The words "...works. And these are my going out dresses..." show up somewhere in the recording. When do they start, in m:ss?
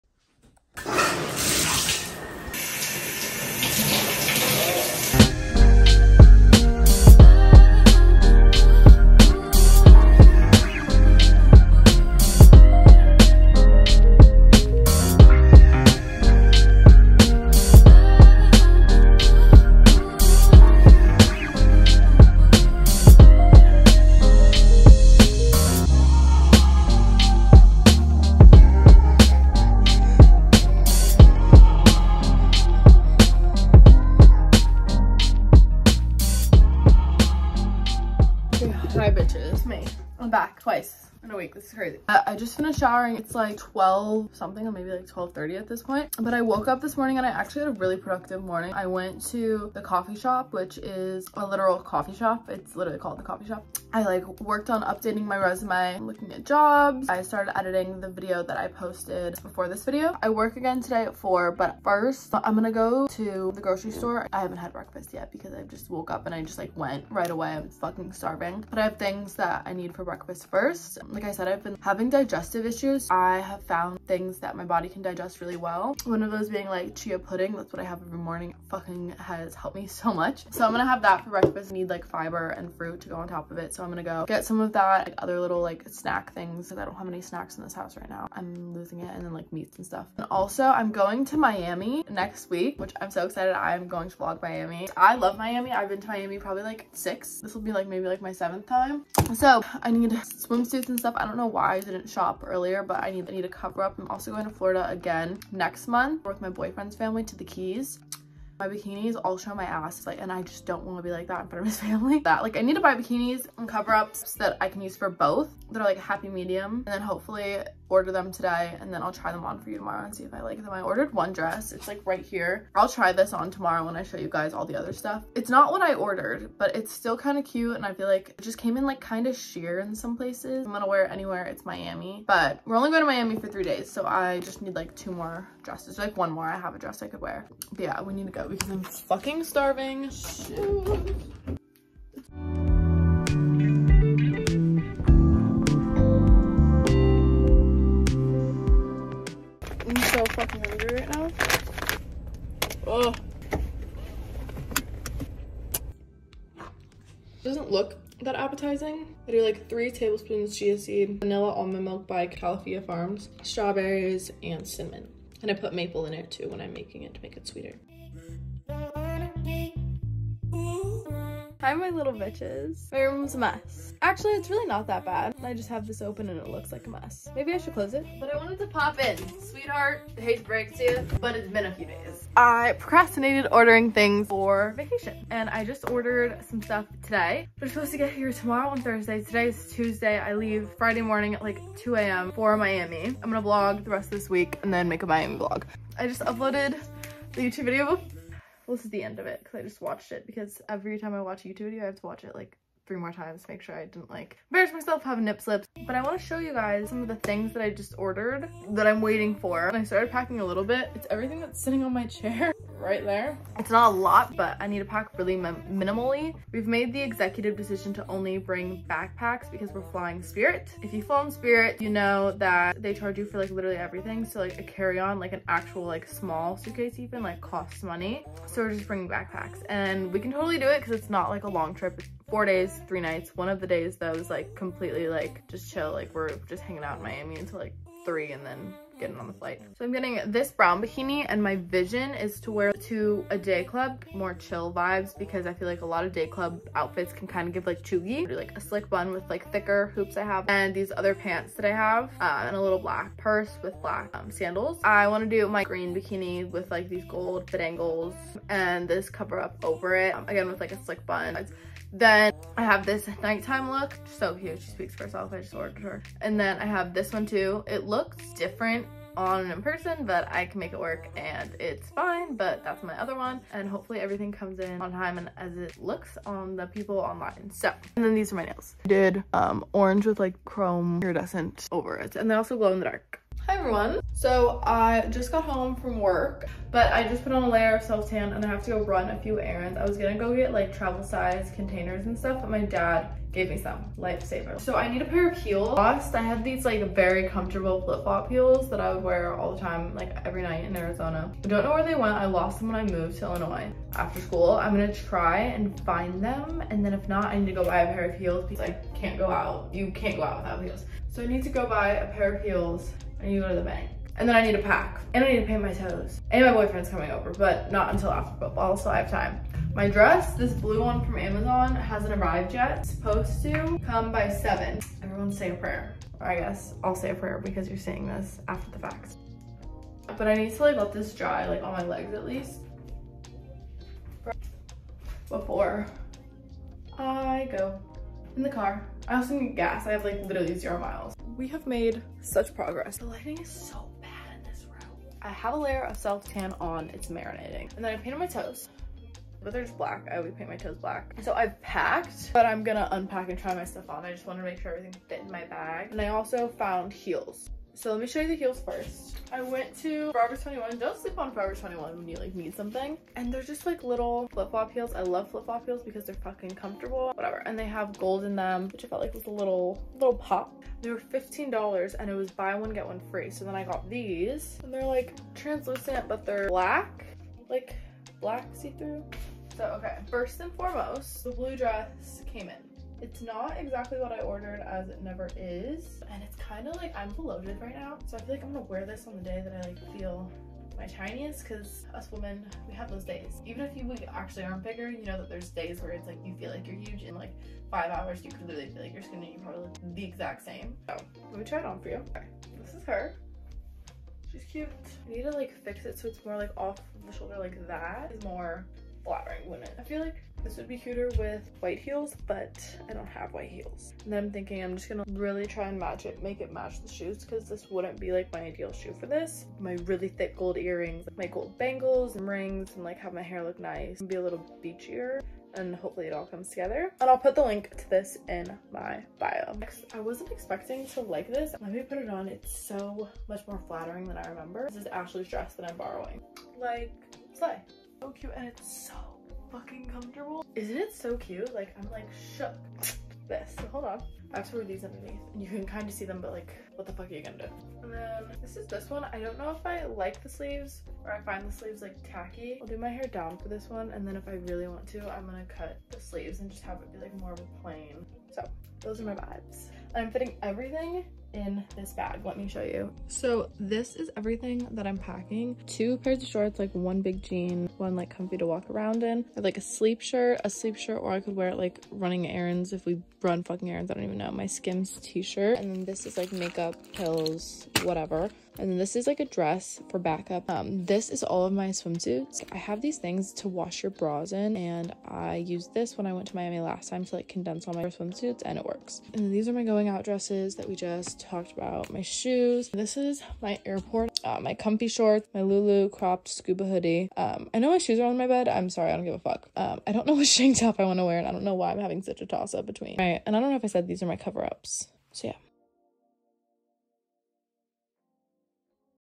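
8:08.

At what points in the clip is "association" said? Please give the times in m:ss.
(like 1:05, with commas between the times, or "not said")
not said.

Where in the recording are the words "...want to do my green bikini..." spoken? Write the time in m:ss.
4:15.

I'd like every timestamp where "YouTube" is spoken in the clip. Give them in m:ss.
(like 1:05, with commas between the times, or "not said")
3:17, 3:21.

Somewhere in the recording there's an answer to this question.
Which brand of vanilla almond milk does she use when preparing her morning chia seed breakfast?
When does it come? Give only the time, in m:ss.
2:42.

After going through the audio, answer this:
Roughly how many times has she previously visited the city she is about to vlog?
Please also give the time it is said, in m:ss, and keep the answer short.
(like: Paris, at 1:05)
6, at 1:36.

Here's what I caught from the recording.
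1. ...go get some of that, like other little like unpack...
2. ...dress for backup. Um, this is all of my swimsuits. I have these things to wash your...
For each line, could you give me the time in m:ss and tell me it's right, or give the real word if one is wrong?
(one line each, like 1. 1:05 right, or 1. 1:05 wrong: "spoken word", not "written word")
1. 1:24 wrong: "snack", not "unpack"
2. 7:59 right.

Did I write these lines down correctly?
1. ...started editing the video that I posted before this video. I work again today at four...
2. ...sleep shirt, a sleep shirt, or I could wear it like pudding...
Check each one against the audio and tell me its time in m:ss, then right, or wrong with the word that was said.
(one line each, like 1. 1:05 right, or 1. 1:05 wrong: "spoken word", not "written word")
1. 0:57 right
2. 7:49 wrong: "running", not "pudding".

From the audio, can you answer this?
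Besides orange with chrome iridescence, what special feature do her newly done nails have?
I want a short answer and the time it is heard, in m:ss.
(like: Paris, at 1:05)
glow in the dark, at 4:42.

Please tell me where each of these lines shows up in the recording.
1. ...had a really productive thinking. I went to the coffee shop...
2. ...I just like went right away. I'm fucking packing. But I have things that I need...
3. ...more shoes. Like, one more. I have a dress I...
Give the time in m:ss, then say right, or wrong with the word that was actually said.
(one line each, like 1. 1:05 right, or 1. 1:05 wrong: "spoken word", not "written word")
1. 0:47 wrong: "morning", not "thinking"
2. 1:06 wrong: "starving", not "packing"
3. 2:15 wrong: "dresses", not "shoes".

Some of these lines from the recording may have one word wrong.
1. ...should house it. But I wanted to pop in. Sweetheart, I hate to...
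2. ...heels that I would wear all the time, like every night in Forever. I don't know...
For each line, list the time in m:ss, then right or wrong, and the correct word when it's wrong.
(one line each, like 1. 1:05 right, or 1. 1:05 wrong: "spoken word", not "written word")
1. 2:57 wrong: "close", not "house"
2. 4:58 wrong: "Arizona", not "Forever".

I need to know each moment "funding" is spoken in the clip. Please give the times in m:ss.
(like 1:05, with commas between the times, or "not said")
not said.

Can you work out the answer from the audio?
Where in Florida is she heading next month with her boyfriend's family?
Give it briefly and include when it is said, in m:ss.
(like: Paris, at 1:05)
the Keys, at 1:47.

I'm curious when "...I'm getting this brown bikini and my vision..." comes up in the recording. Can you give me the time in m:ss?
3:59.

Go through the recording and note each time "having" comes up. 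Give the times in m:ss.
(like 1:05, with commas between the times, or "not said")
1:11, 8:21.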